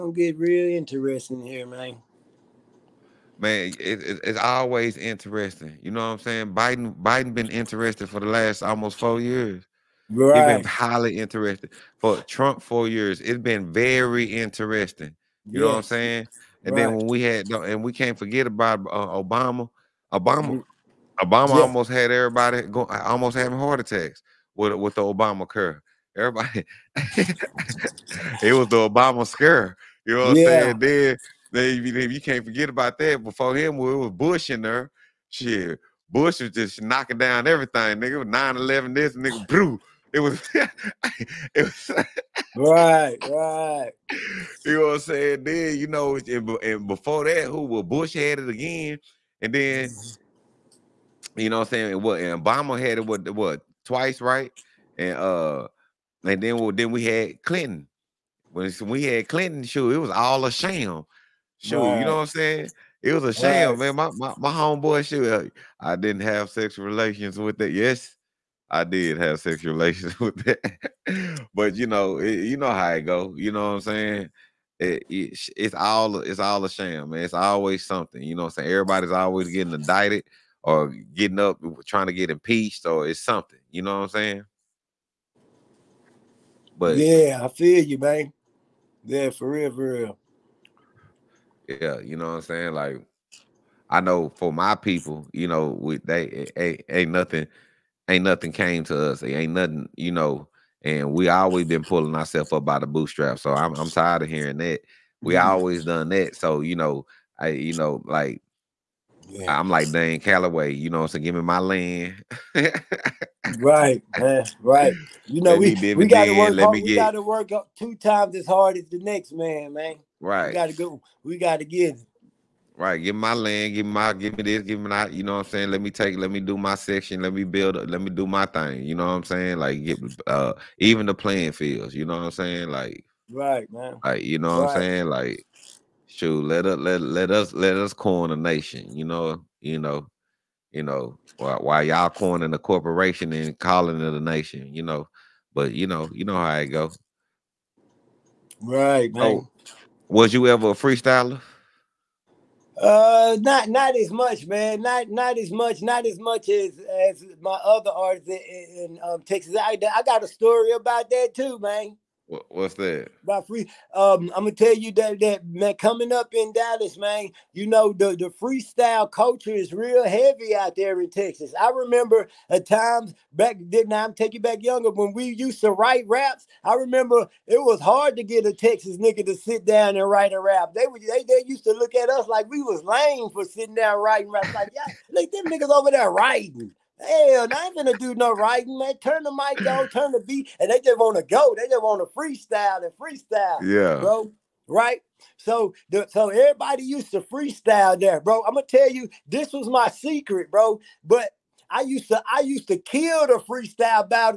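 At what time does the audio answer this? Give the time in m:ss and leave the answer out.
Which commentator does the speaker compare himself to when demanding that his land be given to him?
1:49.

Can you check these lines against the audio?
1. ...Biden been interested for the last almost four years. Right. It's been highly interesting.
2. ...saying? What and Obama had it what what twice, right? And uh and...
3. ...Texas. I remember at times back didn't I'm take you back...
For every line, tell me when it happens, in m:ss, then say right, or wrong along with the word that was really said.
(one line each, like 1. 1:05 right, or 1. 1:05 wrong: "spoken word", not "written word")
1. 0:07 right
2. 0:51 right
3. 2:51 right.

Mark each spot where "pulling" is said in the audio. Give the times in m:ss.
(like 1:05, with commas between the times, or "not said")
1:41.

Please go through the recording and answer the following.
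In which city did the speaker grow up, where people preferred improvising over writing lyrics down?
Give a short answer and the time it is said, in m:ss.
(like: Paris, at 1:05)
Dallas, at 2:46.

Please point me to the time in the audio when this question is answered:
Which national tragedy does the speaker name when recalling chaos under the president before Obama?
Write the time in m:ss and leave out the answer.
0:38.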